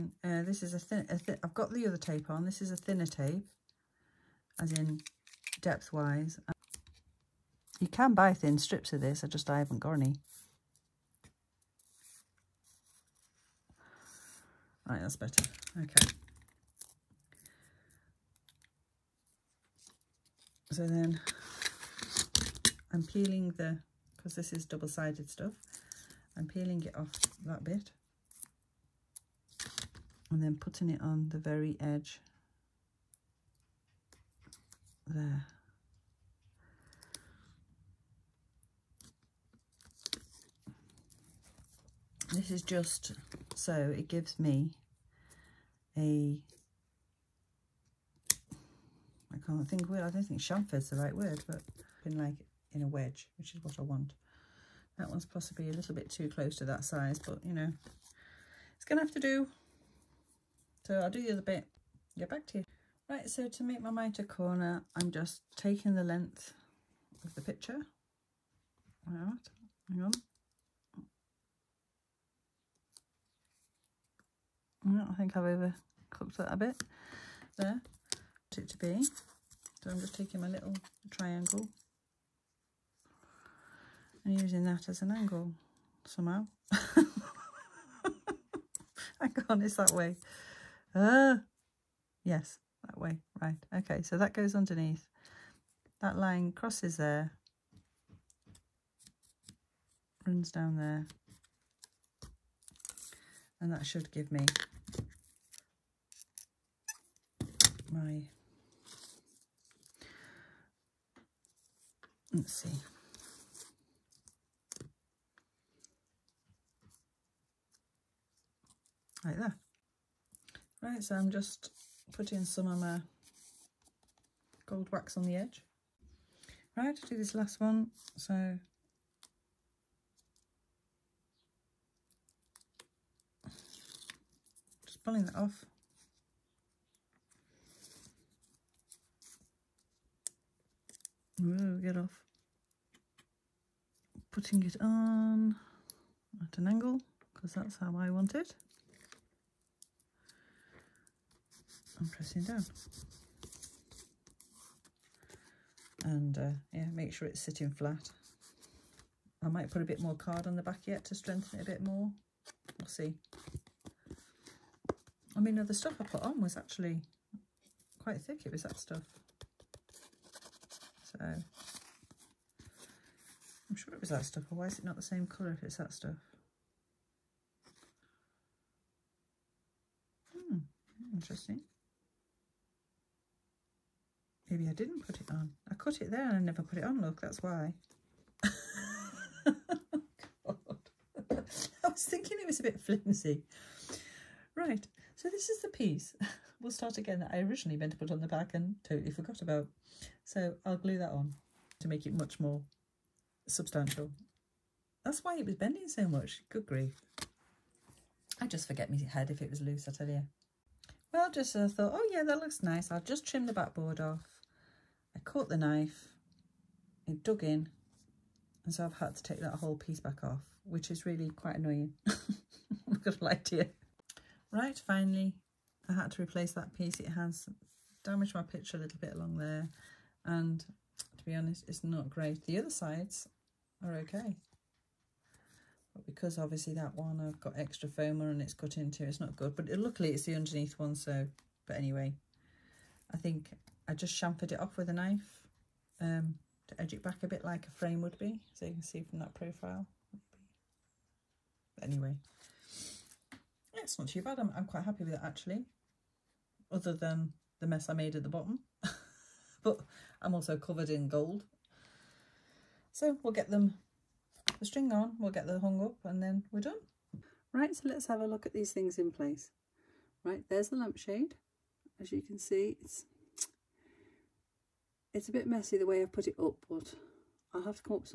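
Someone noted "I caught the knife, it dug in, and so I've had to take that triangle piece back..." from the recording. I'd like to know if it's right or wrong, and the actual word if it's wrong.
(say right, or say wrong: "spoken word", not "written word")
wrong: "whole", not "triangle".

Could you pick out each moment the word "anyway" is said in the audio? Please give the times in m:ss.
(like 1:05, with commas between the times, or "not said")
4:01, 4:11.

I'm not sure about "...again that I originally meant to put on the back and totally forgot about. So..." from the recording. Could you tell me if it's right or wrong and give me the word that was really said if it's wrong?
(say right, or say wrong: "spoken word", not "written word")
right.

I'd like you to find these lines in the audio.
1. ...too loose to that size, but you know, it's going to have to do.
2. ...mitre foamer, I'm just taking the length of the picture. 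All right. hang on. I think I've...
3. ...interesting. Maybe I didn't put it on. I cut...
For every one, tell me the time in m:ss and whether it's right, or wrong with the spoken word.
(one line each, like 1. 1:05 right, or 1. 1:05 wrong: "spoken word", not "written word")
1. 0:56 wrong: "close", not "loose"
2. 1:03 wrong: "corner", not "foamer"
3. 3:01 right.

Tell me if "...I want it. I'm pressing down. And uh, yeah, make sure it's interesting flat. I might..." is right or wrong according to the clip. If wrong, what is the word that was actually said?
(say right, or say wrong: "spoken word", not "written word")
wrong: "sitting", not "interesting".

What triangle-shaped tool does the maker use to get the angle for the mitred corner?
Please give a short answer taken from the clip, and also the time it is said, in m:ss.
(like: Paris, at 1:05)
little triangle, at 1:20.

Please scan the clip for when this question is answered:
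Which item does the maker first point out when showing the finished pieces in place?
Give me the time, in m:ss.
4:30.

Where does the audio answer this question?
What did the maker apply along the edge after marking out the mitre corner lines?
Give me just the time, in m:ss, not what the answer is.
2:04.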